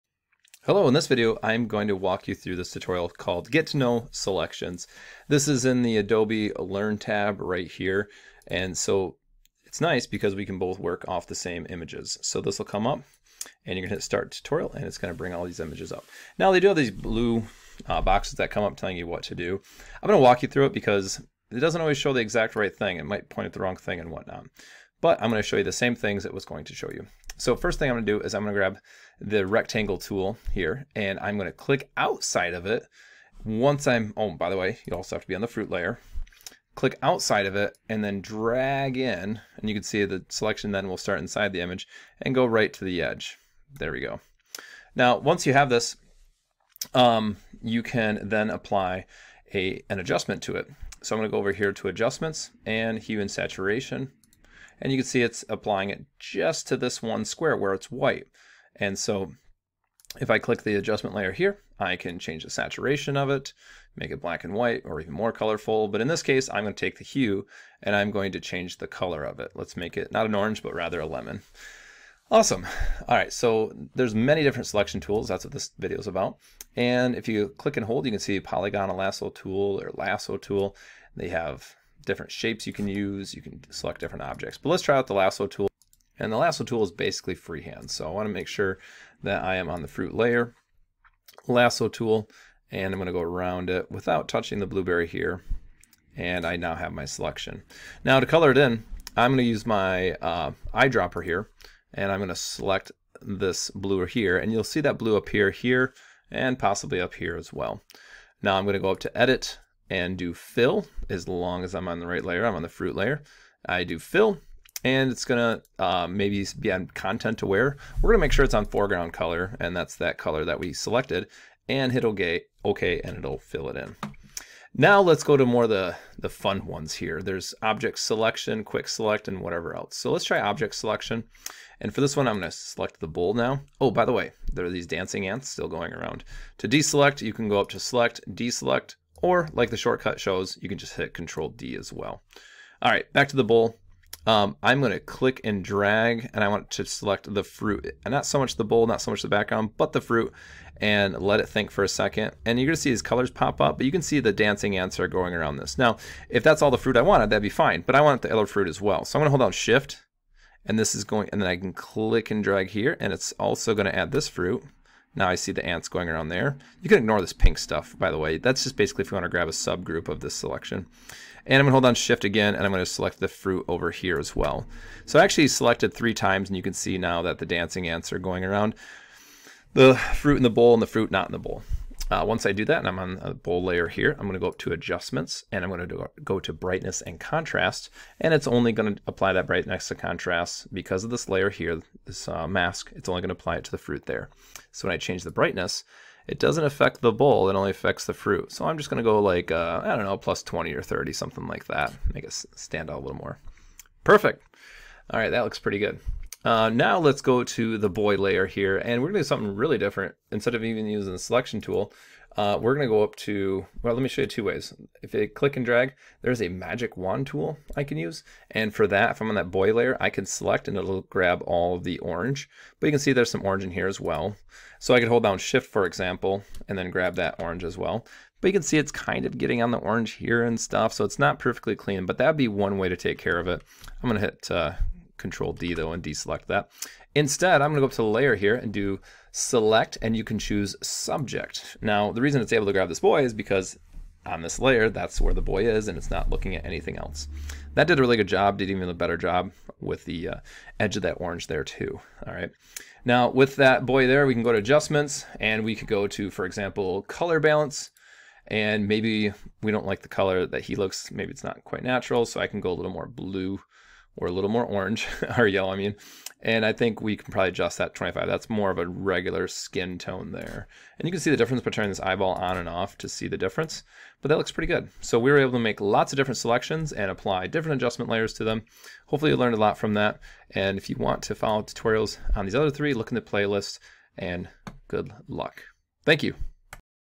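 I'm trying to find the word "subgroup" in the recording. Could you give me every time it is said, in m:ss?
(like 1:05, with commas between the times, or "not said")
2:49.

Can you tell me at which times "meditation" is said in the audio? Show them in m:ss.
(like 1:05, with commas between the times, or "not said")
not said.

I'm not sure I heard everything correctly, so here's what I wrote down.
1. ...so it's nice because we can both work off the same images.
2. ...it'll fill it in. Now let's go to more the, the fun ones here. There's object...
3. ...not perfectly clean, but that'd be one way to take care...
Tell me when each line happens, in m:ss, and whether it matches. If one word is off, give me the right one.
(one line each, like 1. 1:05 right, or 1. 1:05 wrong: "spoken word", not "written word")
1. 0:08 right
2. 2:03 right
3. 3:51 right.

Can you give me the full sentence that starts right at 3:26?
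Uh, now let's go to the boy layer here, and we're going to do something really different.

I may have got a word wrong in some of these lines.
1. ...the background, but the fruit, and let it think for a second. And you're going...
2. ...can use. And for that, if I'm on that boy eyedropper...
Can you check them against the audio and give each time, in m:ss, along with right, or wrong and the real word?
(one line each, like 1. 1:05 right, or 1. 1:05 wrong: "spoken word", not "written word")
1. 2:29 right
2. 3:37 wrong: "layer", not "eyedropper".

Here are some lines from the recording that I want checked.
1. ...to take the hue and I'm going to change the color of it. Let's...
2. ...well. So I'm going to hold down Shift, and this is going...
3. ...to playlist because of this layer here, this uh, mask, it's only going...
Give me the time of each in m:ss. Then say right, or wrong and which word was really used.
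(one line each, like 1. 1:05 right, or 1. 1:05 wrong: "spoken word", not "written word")
1. 1:06 right
2. 2:38 right
3. 3:09 wrong: "contrast", not "playlist".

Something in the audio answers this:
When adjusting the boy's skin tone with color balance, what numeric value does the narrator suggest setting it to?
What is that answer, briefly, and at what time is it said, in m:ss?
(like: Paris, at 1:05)
25, at 4:27.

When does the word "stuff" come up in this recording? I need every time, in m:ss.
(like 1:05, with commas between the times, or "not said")
2:47, 3:50.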